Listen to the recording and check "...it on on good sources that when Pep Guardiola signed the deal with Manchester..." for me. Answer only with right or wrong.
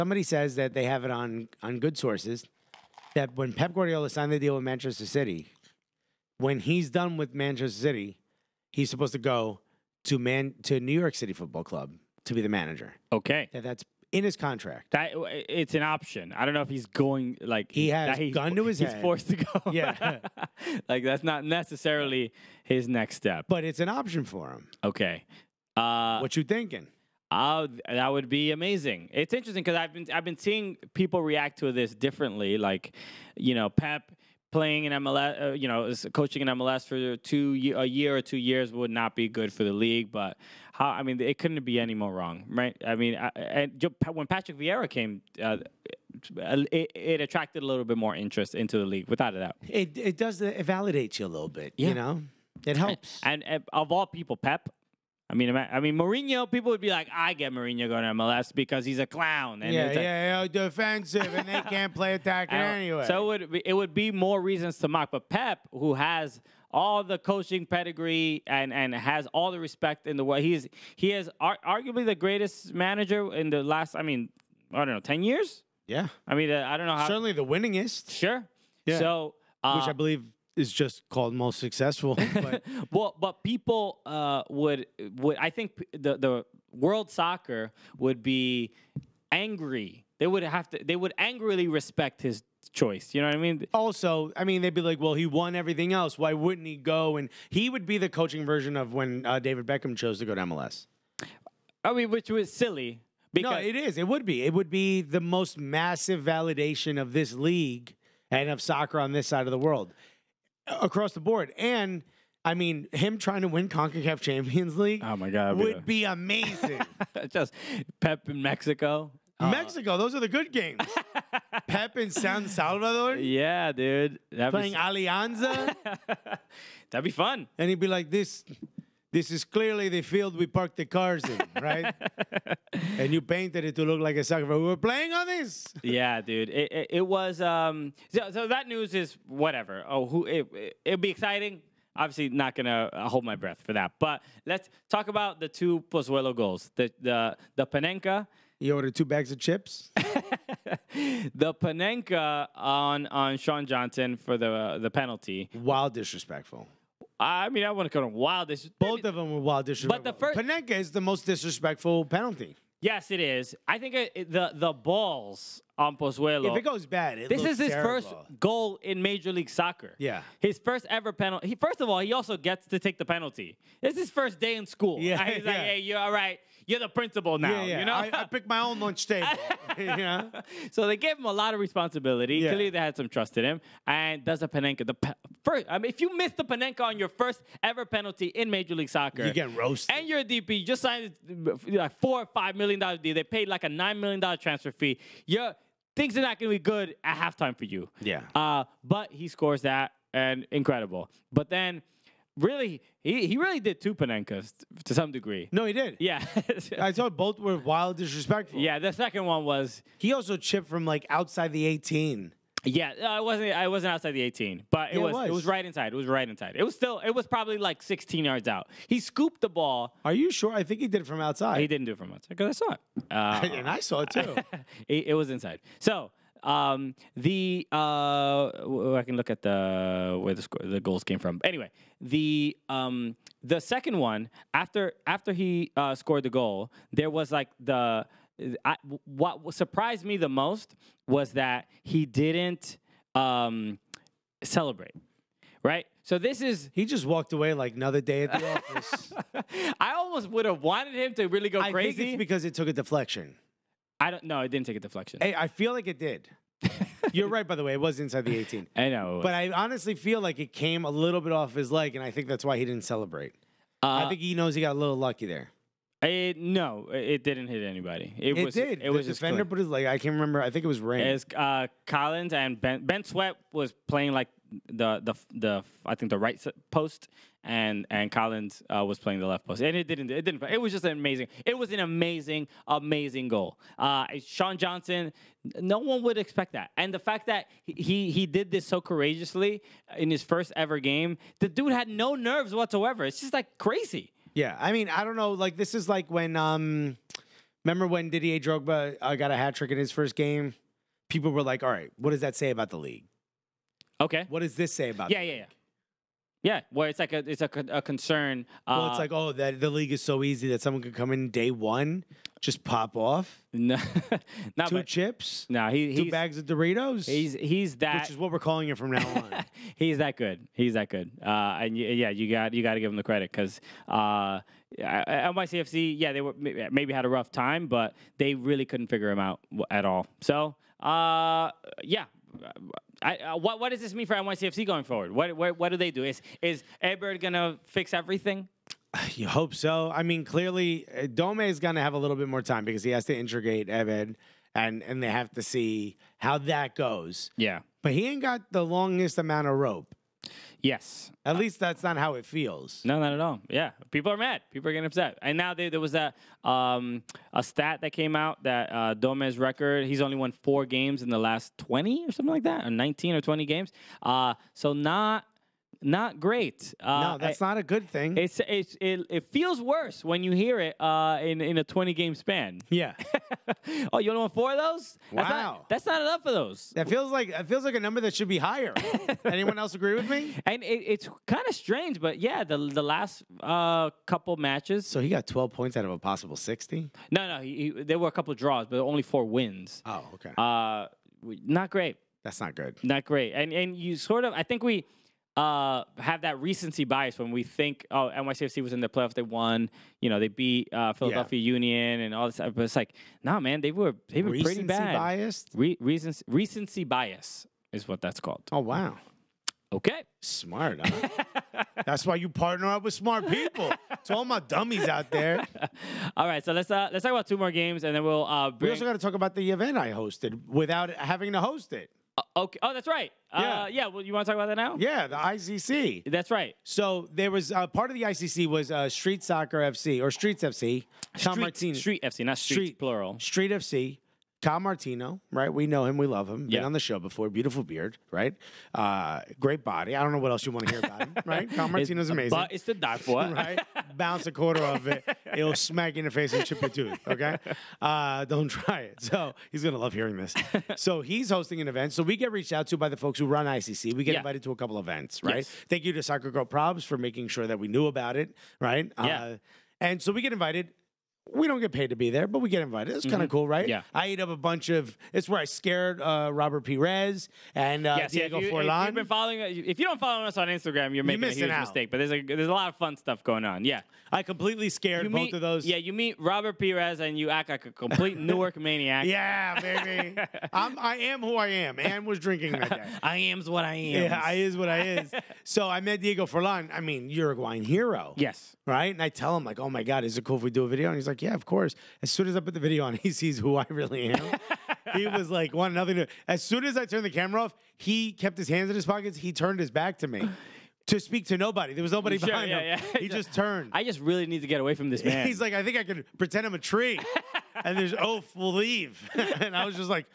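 right.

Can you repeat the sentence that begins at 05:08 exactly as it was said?
Well, uh, it's like oh that the league is so easy that someone could come in day one, just pop off.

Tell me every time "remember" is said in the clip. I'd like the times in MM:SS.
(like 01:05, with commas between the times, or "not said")
04:30, 04:57.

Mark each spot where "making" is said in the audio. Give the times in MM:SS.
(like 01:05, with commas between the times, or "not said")
07:36, 07:51.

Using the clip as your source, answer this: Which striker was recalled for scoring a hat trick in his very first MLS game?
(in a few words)
Didier Drogba.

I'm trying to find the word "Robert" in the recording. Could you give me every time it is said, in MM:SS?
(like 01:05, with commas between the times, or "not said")
07:46, 07:56.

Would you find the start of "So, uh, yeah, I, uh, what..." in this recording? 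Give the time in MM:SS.
05:30.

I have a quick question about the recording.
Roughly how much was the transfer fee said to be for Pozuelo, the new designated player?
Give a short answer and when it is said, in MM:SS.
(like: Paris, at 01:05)
9 million dollars, at 03:13.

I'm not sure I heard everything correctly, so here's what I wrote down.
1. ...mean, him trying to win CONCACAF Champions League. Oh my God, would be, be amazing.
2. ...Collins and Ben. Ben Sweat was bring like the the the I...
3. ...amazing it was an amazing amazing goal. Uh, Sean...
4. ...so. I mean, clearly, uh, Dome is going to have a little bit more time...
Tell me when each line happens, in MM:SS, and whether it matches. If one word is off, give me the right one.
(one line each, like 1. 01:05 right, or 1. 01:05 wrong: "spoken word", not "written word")
1. 01:52 right
2. 04:31 wrong: "playing", not "bring"
3. 04:40 right
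4. 05:39 right.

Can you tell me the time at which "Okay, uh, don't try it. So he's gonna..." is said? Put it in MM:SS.
07:27.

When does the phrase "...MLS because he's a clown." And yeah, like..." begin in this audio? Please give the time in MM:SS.
00:58.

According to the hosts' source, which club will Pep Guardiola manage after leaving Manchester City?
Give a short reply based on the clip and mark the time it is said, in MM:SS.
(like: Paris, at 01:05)
New York City Football Club, at 00:10.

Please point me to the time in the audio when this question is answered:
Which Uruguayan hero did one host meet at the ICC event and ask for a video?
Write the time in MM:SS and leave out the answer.
08:05.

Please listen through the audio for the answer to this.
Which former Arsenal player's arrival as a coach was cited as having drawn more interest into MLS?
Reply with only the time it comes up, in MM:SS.
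00:44.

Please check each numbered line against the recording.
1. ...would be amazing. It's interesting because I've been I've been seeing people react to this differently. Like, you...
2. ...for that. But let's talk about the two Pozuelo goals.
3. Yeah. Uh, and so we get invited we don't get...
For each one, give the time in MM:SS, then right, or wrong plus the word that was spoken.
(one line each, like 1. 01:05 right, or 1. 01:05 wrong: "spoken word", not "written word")
1. 00:28 right
2. 02:23 right
3. 07:38 right.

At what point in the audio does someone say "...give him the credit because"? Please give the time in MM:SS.
05:22.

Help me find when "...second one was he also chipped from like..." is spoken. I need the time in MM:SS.
03:28.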